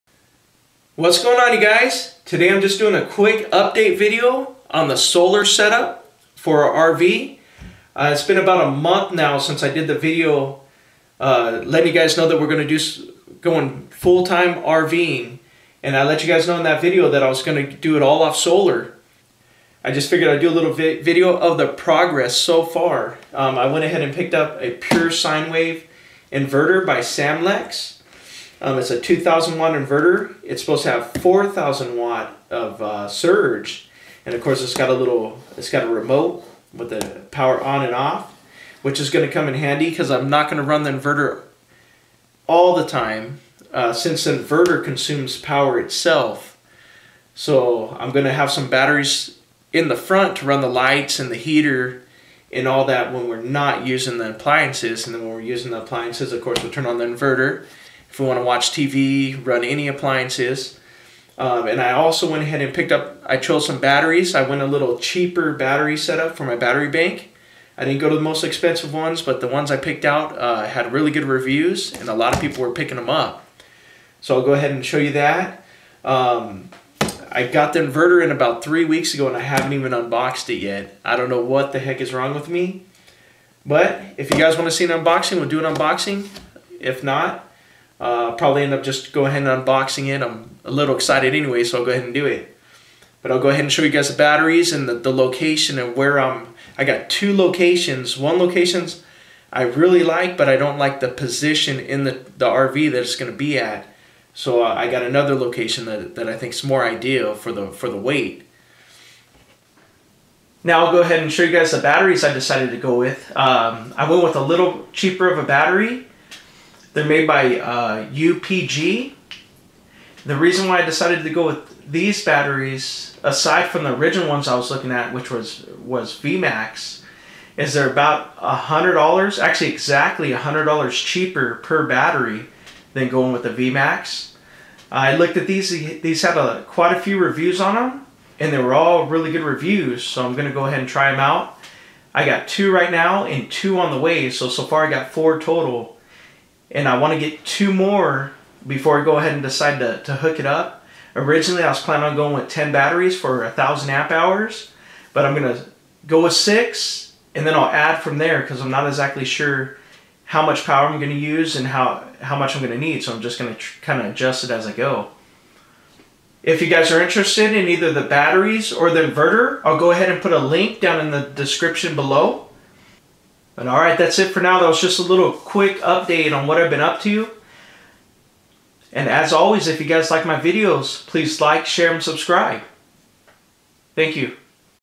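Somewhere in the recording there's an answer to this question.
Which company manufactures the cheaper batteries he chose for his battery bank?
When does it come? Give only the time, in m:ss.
1:58.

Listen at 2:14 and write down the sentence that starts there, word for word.
I looked at these; these had a, quite a few reviews on them, and they were all really good reviews.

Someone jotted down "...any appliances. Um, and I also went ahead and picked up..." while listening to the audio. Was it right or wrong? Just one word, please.
right.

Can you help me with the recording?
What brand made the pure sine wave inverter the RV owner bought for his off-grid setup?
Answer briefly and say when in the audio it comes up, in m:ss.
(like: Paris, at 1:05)
Samlex, at 0:26.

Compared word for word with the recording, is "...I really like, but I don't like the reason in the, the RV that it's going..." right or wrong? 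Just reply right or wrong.
wrong.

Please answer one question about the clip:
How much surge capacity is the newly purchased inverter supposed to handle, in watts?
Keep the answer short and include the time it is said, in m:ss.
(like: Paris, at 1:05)
4,000 watt, at 0:31.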